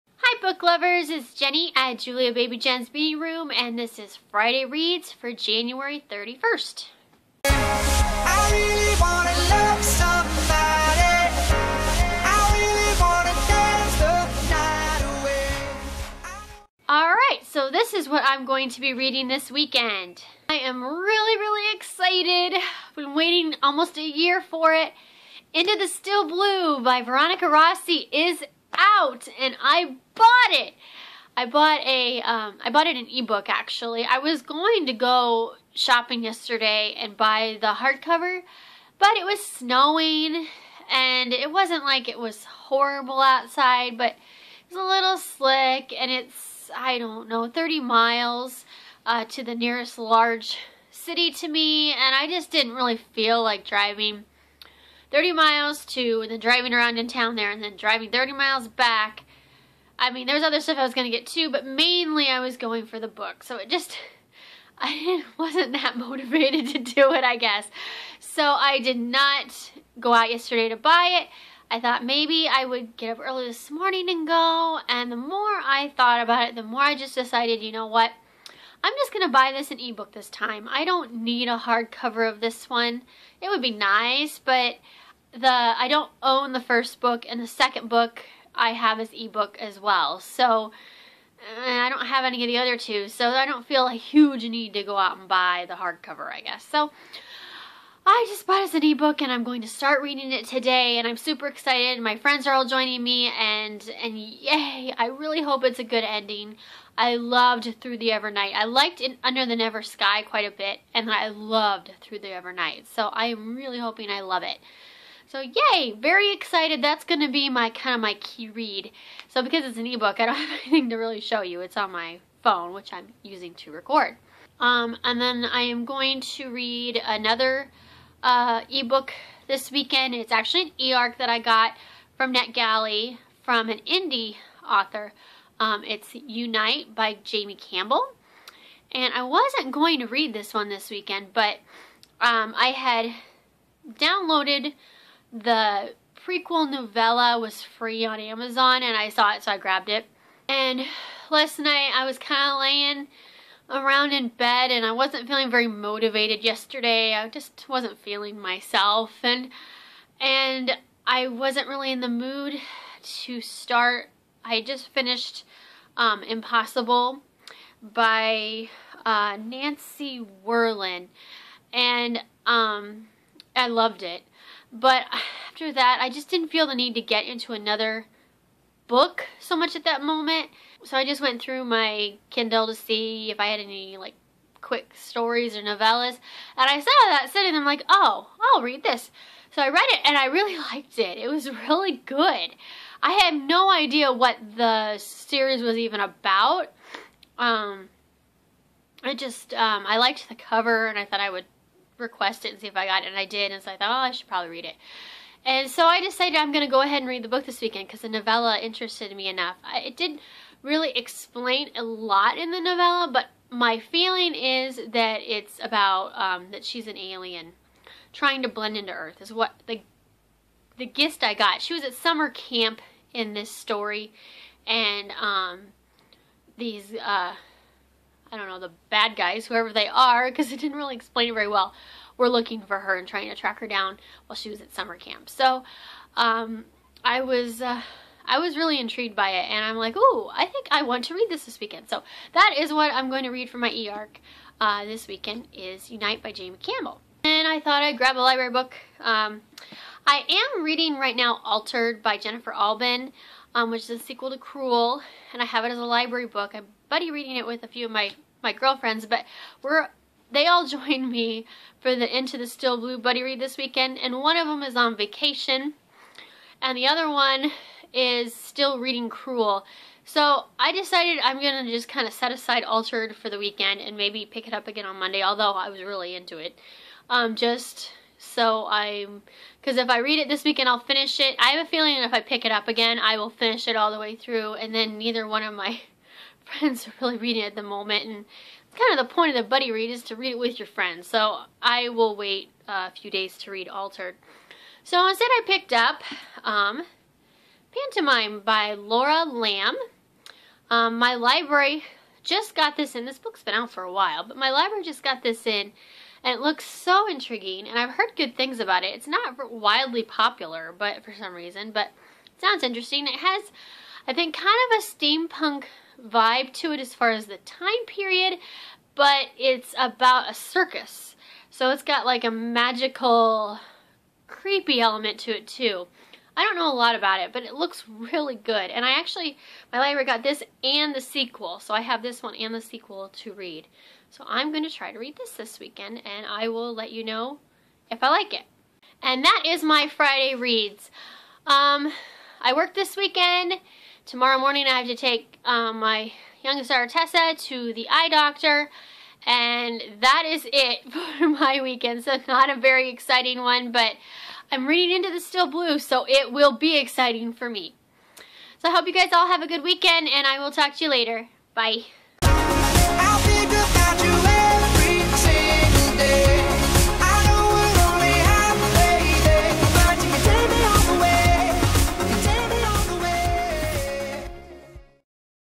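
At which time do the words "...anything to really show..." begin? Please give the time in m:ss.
2:00.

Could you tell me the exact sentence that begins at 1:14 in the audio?
And the more I thought about it, the more I just decided, you know what?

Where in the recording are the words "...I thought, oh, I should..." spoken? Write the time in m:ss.
3:23.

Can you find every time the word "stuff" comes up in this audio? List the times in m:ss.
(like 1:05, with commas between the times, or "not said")
1:00.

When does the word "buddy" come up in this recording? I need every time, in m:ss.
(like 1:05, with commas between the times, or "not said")
4:16, 4:22, 4:49.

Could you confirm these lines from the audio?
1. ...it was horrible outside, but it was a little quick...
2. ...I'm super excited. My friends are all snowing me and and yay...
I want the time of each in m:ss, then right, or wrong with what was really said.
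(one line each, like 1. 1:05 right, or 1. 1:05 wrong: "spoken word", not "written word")
1. 0:42 wrong: "slick", not "quick"
2. 1:41 wrong: "joining", not "snowing".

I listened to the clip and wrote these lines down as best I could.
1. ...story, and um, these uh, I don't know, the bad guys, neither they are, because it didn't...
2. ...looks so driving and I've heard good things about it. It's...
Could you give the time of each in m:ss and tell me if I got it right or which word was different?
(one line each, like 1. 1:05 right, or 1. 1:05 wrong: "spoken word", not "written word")
1. 3:43 wrong: "whoever", not "neither"
2. 5:06 wrong: "intriguing", not "driving".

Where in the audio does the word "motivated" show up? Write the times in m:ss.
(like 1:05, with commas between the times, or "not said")
1:05, 2:35.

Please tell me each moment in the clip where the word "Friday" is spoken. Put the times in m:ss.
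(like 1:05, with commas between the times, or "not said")
0:04, 5:39.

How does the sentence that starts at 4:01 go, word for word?
So that is what I'm going to read for my e-arc uh, this weekend is Unite by Jamie Campbell.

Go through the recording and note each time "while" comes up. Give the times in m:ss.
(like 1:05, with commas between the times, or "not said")
3:54, 5:03.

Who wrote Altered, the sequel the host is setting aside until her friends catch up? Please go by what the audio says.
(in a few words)
Jennifer Albin.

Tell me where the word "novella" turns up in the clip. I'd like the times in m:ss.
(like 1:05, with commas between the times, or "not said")
2:26, 3:05, 3:28, 3:32.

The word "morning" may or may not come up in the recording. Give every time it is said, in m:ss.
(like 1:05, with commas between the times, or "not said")
1:13, 5:44.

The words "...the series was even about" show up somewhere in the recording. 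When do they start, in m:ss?
3:14.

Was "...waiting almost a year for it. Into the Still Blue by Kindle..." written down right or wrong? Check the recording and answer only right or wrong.
wrong.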